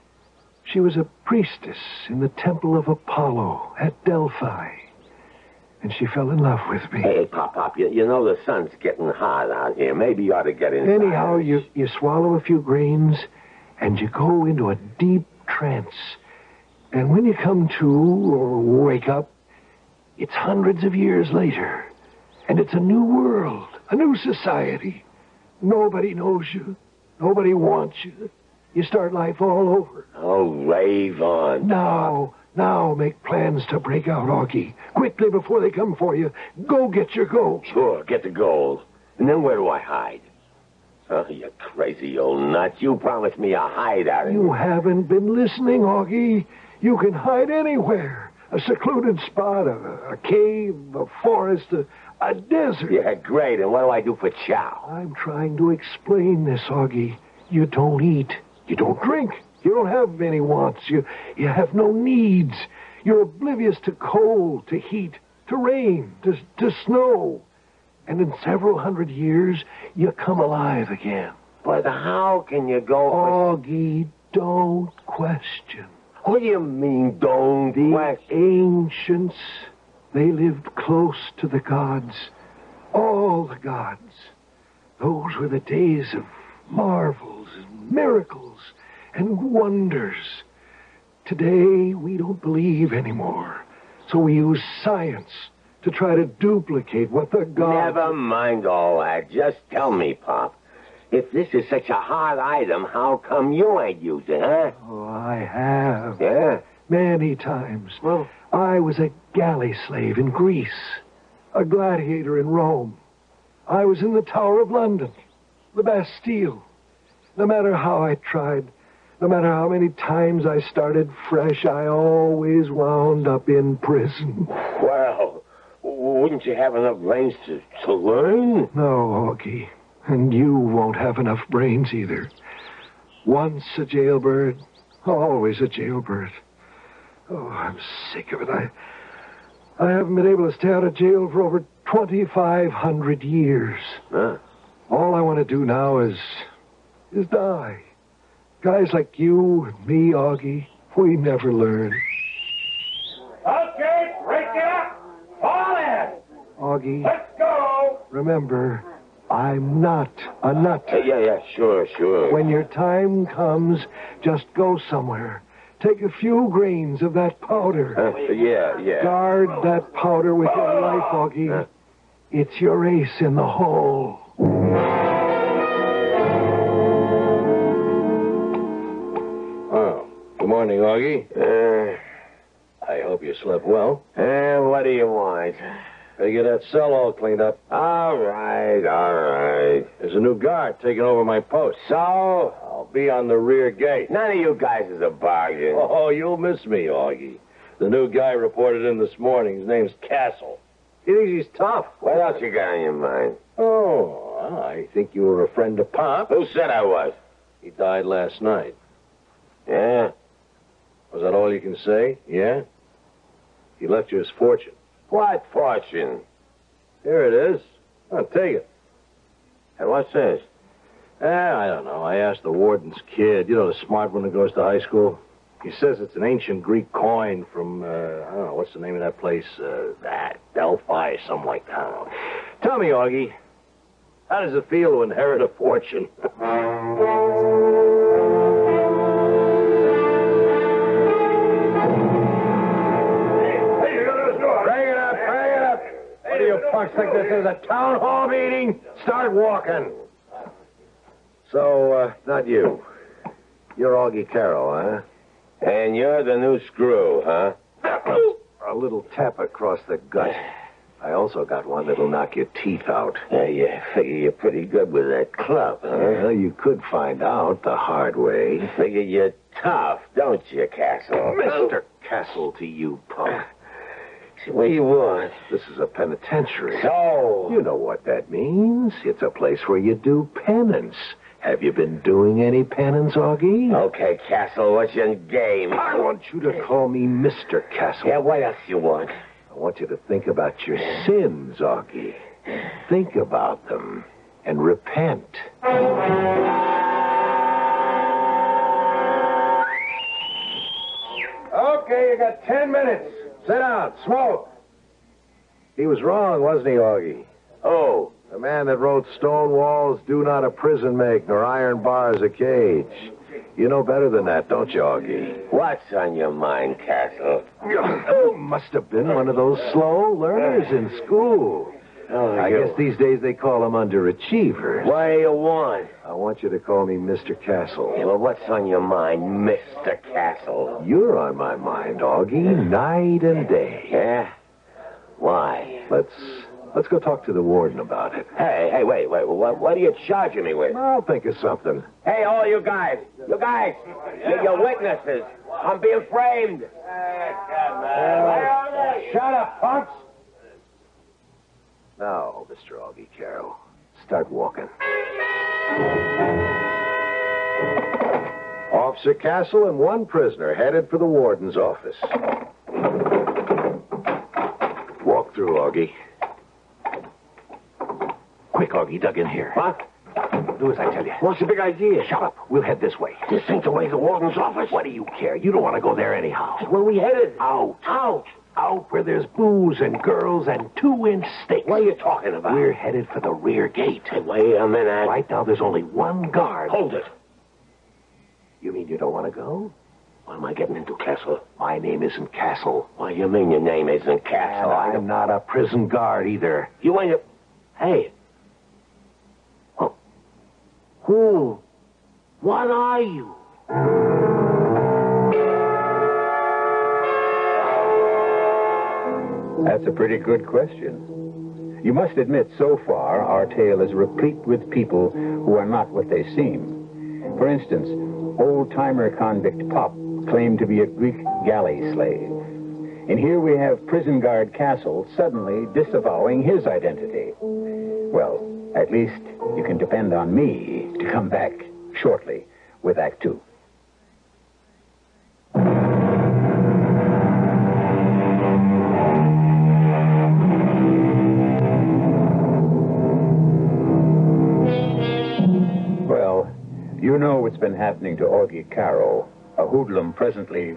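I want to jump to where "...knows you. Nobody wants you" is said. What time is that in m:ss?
0:26.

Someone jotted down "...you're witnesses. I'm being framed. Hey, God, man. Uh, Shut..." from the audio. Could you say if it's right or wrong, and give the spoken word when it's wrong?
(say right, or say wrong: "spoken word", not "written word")
right.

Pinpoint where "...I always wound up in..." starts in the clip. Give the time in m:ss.
2:01.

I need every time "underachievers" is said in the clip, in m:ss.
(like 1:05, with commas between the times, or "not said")
5:23.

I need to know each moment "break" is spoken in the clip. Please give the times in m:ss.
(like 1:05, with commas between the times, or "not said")
0:33, 2:34.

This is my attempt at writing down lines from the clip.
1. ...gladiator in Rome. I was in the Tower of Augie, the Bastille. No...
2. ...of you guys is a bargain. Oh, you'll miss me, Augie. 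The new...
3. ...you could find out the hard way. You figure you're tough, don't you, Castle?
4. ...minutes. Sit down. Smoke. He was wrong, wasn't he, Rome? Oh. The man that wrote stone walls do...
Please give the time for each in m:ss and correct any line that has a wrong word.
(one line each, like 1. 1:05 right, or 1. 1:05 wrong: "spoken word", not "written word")
1. 1:51 wrong: "London", not "Augie"
2. 3:14 right
3. 4:26 right
4. 5:02 wrong: "Augie", not "Rome".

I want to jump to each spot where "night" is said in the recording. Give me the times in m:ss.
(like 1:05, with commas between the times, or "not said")
3:28, 5:32.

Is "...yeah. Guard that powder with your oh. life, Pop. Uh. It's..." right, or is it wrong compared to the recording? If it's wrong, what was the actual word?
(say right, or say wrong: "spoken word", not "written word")
wrong: "Augie", not "Pop".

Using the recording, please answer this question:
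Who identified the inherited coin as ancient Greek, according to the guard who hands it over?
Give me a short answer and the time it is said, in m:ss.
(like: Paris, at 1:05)
The warden's kid, at 3:42.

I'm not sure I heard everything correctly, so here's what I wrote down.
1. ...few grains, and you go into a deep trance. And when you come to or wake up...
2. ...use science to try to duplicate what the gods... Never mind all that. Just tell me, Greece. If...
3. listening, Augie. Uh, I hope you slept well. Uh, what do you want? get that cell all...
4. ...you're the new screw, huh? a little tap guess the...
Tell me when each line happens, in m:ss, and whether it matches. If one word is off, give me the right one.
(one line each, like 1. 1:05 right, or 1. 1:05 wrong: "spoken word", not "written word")
1. 0:12 right
2. 1:34 wrong: "Pop", not "Greece"
3. 3:00 wrong: "morning", not "listening"
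4. 4:15 wrong: "across", not "guess".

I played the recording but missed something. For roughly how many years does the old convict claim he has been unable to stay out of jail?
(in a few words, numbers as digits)
2,500.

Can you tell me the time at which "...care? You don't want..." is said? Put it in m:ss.
6:15.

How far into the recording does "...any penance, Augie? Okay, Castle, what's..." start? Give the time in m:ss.
4:42.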